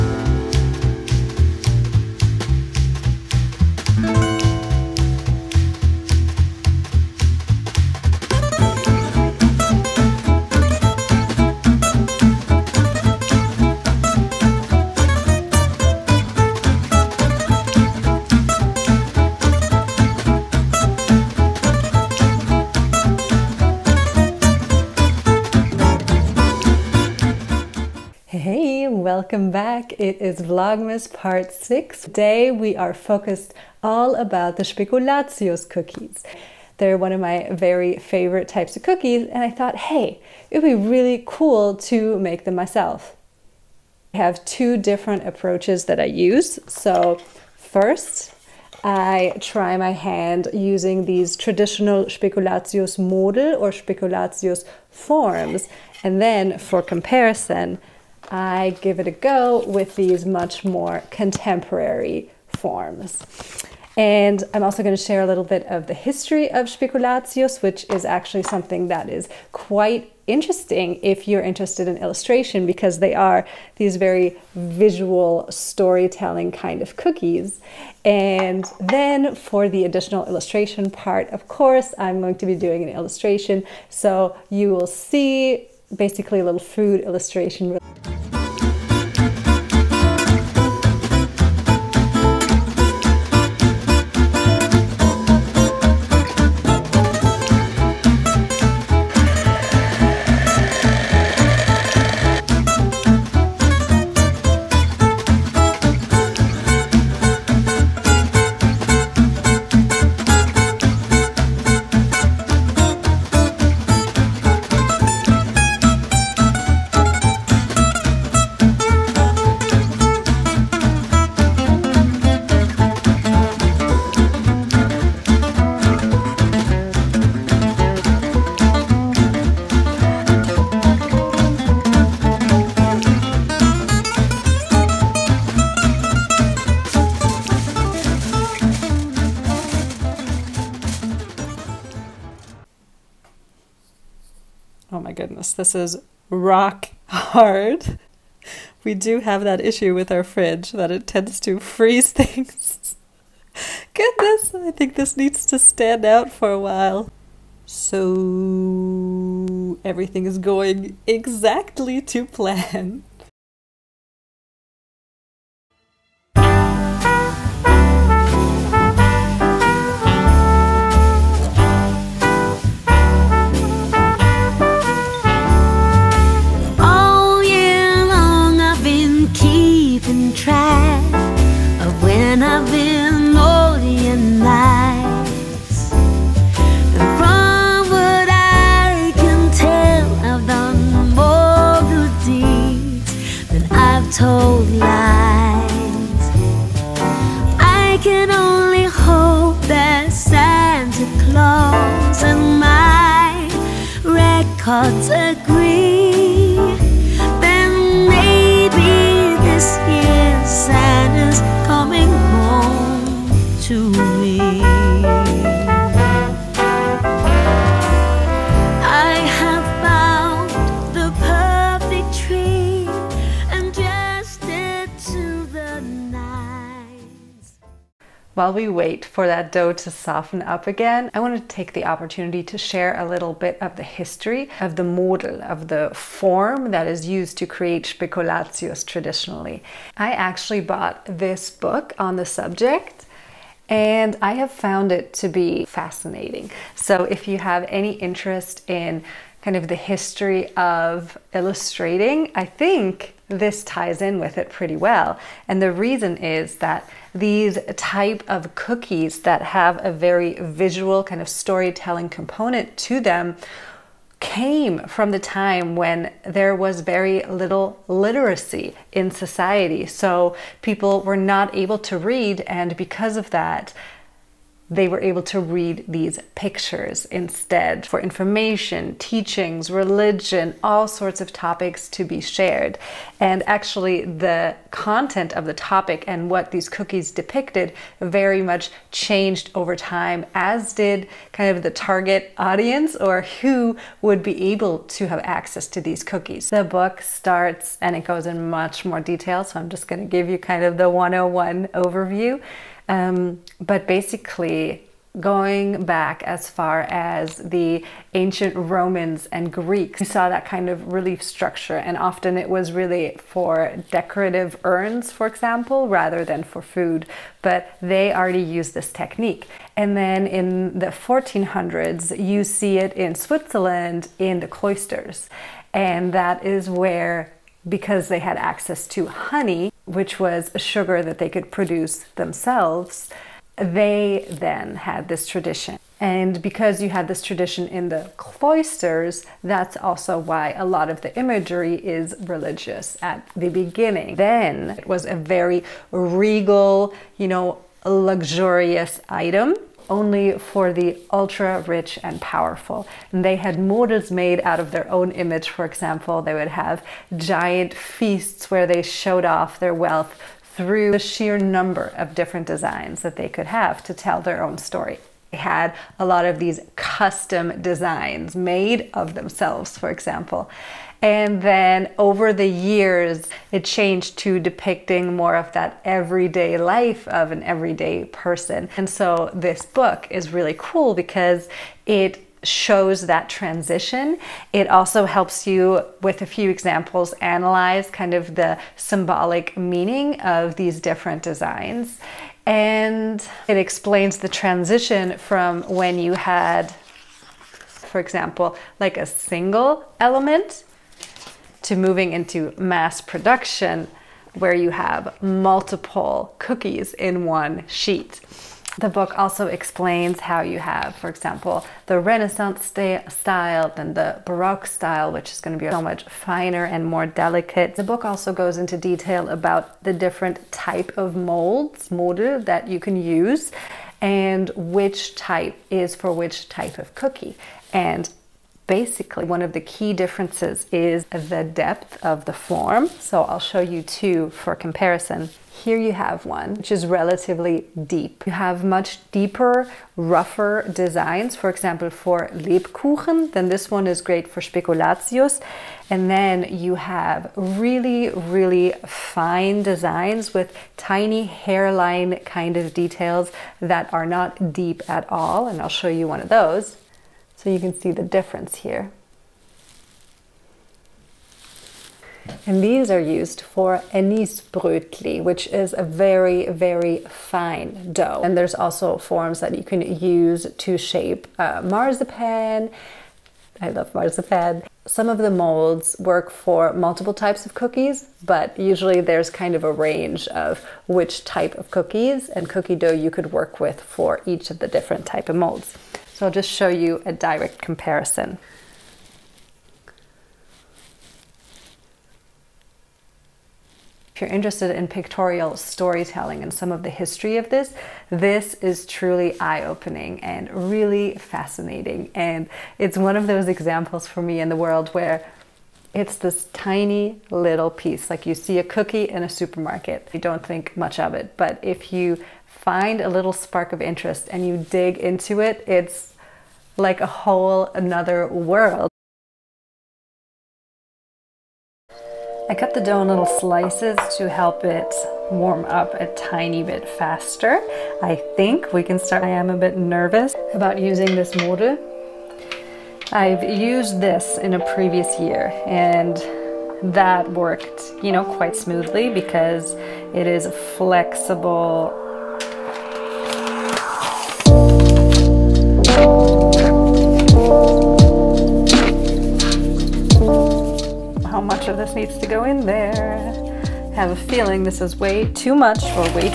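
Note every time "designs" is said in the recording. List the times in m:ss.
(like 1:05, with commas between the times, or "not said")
6:02, 6:07, 6:31, 7:20, 7:29.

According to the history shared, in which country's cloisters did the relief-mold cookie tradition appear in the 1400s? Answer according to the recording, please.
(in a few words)
Switzerland.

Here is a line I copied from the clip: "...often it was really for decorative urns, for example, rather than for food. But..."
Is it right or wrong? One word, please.
right.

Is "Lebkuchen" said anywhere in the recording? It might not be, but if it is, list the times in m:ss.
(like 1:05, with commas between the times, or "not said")
7:22.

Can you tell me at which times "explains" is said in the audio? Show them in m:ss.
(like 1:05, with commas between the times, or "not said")
6:33, 6:49.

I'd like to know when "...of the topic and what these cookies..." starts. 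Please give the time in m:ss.
4:45.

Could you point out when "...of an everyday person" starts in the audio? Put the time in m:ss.
6:17.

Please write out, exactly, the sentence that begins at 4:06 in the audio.
So if you have any interest in kind of the history of illustrating, I think this ties in with it pretty well.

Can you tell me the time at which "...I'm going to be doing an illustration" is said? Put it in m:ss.
1:21.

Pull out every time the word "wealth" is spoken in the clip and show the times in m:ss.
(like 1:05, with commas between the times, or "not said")
5:59.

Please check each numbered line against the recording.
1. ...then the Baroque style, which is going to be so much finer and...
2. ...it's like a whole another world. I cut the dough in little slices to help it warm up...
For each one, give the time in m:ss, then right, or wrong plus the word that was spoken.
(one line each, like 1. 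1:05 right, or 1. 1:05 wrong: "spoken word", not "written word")
1. 6:53 right
2. 8:35 right.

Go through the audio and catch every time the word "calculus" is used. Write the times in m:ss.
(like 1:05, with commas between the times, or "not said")
not said.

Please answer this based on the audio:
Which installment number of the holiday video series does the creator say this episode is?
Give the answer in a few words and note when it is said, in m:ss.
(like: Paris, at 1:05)
6, at 0:31.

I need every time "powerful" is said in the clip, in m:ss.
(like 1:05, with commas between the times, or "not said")
5:52.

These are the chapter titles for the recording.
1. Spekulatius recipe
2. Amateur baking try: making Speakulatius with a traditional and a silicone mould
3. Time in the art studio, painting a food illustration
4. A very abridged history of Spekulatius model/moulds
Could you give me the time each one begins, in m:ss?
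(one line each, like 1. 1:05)
1. 1:28
2. 8:39
3. 2:43
4. 3:50.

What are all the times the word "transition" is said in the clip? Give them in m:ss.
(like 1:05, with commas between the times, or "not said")
6:23, 6:34.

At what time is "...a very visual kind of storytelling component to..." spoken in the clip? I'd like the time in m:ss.
4:19.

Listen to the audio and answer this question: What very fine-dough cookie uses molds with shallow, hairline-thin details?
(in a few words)
Anisbrötli.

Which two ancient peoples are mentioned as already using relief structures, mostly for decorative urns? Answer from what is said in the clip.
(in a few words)
Romans and Greeks.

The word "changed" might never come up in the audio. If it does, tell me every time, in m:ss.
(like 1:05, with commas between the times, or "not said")
4:48, 6:13.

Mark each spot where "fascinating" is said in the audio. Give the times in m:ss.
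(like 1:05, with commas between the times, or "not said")
4:05, 8:21.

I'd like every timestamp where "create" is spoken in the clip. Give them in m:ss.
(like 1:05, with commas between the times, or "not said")
3:57.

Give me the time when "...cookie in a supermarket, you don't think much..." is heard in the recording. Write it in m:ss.
8:28.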